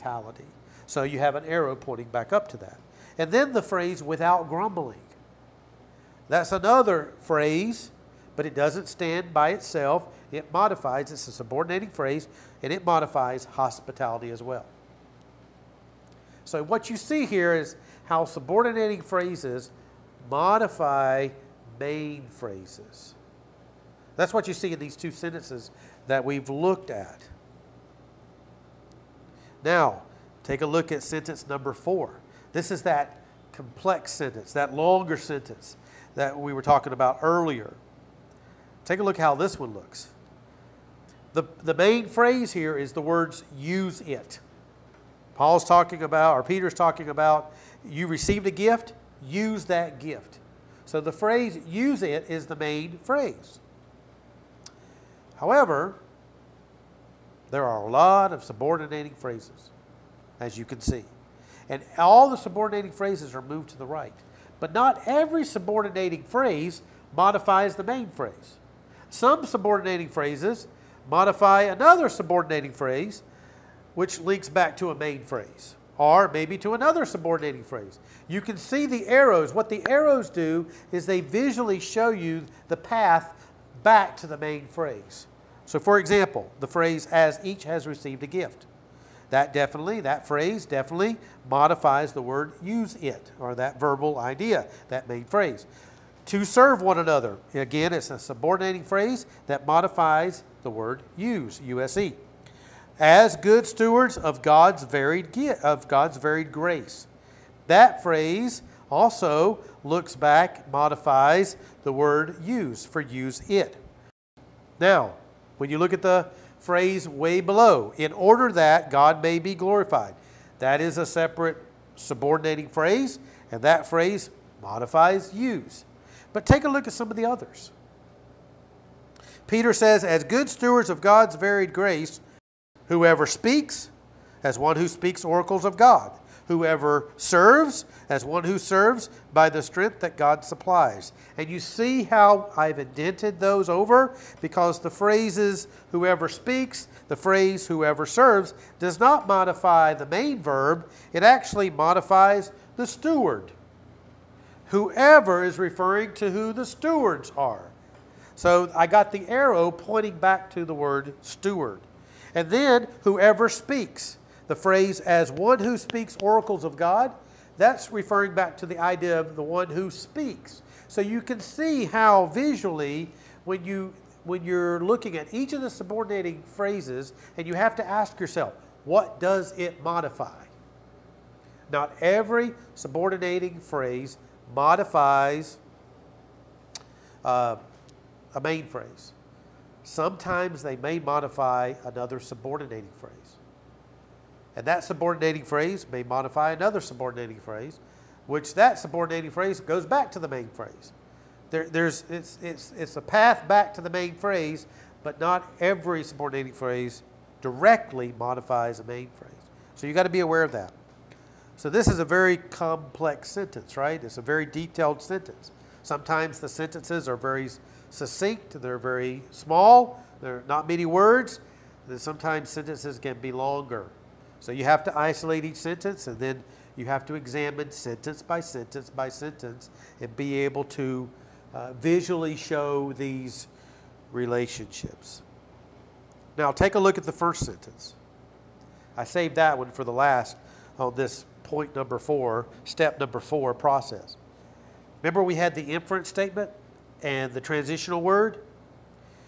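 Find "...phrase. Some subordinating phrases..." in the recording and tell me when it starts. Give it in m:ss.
1:08.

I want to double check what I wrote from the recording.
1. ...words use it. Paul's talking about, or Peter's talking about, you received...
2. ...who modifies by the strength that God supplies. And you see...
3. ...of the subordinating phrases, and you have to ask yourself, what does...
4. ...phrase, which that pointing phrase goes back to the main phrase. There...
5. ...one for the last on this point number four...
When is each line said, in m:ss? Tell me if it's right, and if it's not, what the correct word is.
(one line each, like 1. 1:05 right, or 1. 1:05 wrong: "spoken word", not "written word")
1. 0:43 right
2. 2:18 wrong: "serves", not "modifies"
3. 2:55 right
4. 3:17 wrong: "subordinating", not "pointing"
5. 3:59 right.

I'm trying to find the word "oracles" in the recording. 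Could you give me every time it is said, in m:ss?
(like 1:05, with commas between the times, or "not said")
2:15, 2:46.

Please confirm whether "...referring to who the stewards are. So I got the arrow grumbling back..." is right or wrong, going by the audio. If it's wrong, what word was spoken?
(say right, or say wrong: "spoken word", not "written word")
wrong: "pointing", not "grumbling".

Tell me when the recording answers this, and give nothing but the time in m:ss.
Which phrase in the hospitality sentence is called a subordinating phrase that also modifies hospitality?
0:04.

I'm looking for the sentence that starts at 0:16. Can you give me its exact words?
So what you see here is how subordinating phrases modify main phrases.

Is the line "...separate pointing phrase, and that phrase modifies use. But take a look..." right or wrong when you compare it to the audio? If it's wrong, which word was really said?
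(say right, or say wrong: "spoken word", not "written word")
wrong: "subordinating", not "pointing".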